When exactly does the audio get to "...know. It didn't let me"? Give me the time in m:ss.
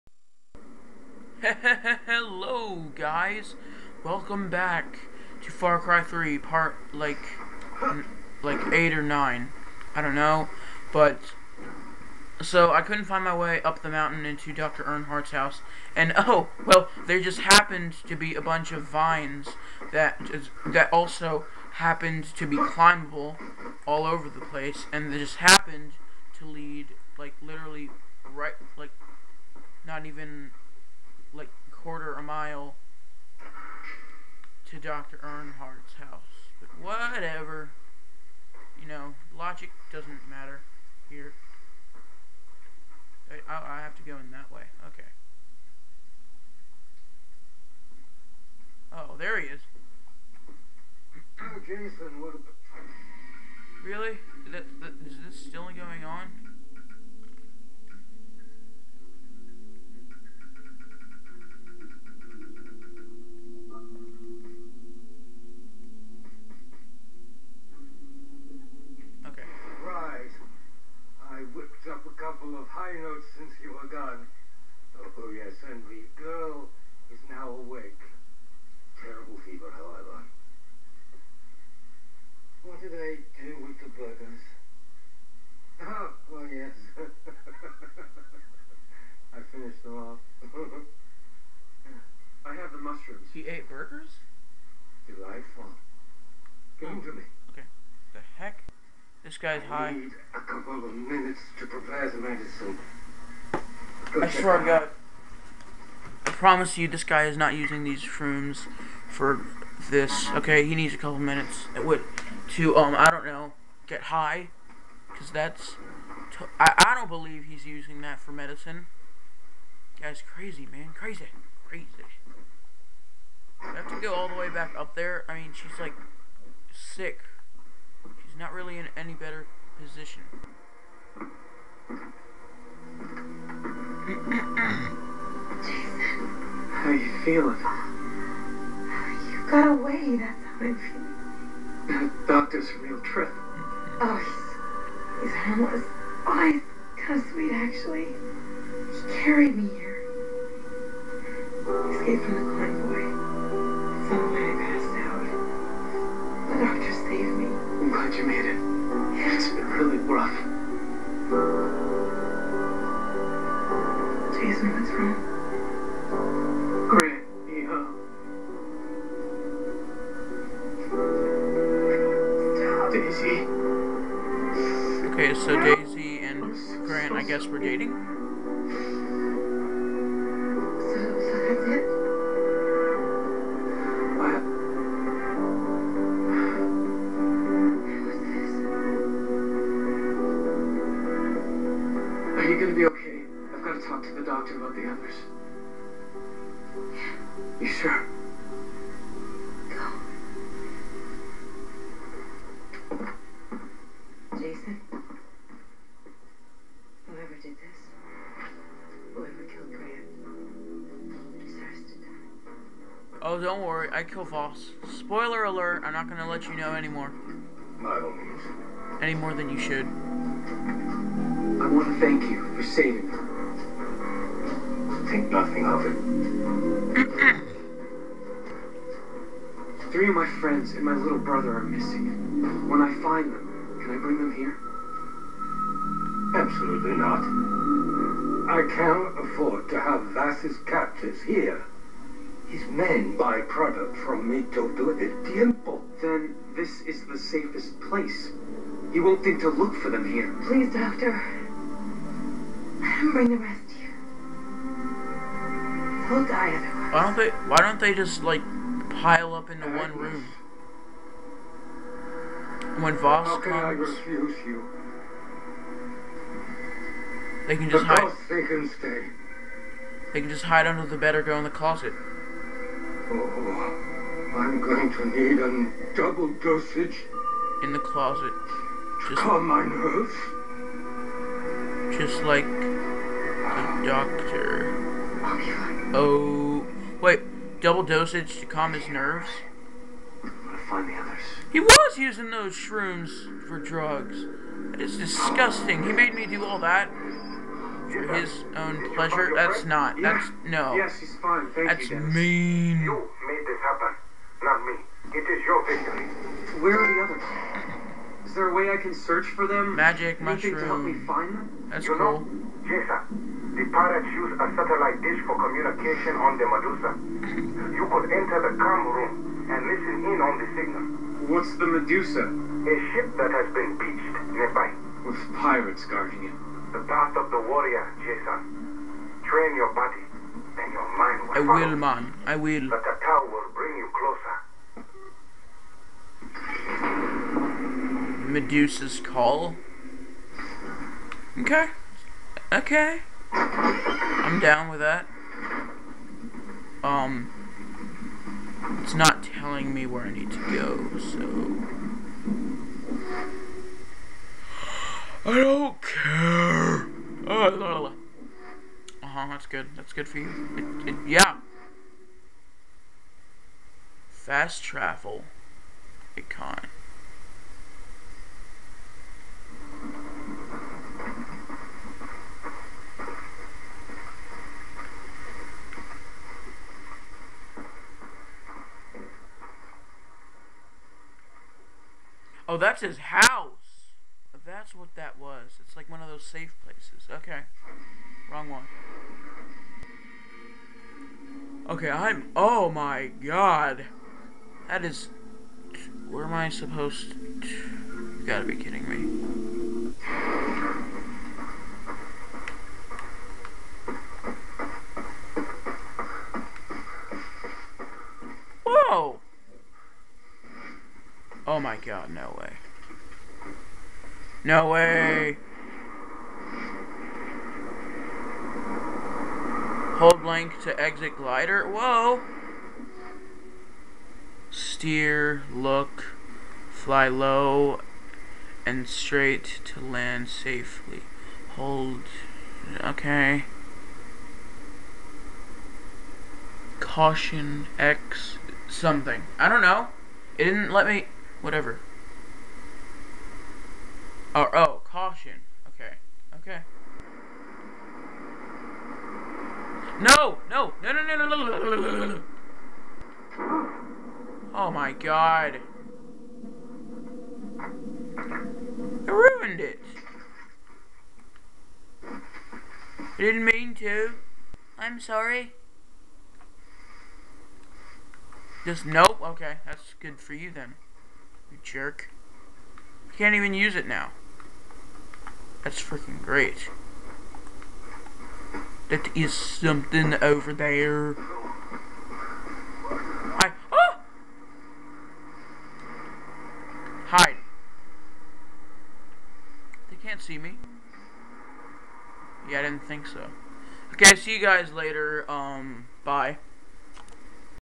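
7:19.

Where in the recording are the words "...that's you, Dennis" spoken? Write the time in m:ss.
5:01.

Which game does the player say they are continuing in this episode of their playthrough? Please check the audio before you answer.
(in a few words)
Far Cry 3.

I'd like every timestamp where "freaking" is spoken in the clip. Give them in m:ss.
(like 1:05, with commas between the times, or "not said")
7:55.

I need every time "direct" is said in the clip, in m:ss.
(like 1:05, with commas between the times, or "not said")
not said.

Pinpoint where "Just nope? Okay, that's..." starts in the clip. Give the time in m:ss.
7:48.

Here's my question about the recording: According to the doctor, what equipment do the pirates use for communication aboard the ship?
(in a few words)
satellite dish.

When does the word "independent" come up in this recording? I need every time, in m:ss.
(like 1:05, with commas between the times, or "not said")
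not said.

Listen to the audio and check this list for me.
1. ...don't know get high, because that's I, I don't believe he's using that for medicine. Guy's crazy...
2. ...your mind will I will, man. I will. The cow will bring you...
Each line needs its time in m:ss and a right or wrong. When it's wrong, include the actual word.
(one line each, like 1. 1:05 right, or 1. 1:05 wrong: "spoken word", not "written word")
1. 1:53 right
2. 5:30 right.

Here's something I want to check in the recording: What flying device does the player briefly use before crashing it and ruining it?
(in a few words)
glider.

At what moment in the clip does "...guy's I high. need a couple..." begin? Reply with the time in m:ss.
1:39.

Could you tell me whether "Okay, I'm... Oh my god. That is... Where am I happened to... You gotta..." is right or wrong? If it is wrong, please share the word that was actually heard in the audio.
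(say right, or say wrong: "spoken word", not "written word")
wrong: "supposed", not "happened".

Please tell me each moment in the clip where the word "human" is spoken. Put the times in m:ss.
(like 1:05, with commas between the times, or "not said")
not said.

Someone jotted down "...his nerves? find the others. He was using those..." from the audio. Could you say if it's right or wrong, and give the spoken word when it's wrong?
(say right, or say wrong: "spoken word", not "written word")
right.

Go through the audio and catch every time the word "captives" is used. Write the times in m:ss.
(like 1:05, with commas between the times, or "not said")
4:00.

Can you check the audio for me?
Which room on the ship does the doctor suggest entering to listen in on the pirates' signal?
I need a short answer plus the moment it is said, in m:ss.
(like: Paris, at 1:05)
com room, at 5:18.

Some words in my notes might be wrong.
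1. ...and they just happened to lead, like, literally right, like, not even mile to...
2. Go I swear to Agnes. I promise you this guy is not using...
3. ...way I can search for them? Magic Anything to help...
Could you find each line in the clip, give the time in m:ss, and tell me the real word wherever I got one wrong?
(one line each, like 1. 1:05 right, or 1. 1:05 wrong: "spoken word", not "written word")
1. 0:24 right
2. 1:44 wrong: "God", not "Agnes"
3. 5:08 right.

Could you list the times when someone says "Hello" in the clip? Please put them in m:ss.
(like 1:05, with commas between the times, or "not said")
0:02.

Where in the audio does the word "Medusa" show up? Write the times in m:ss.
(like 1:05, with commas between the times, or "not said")
5:16, 5:21, 5:38.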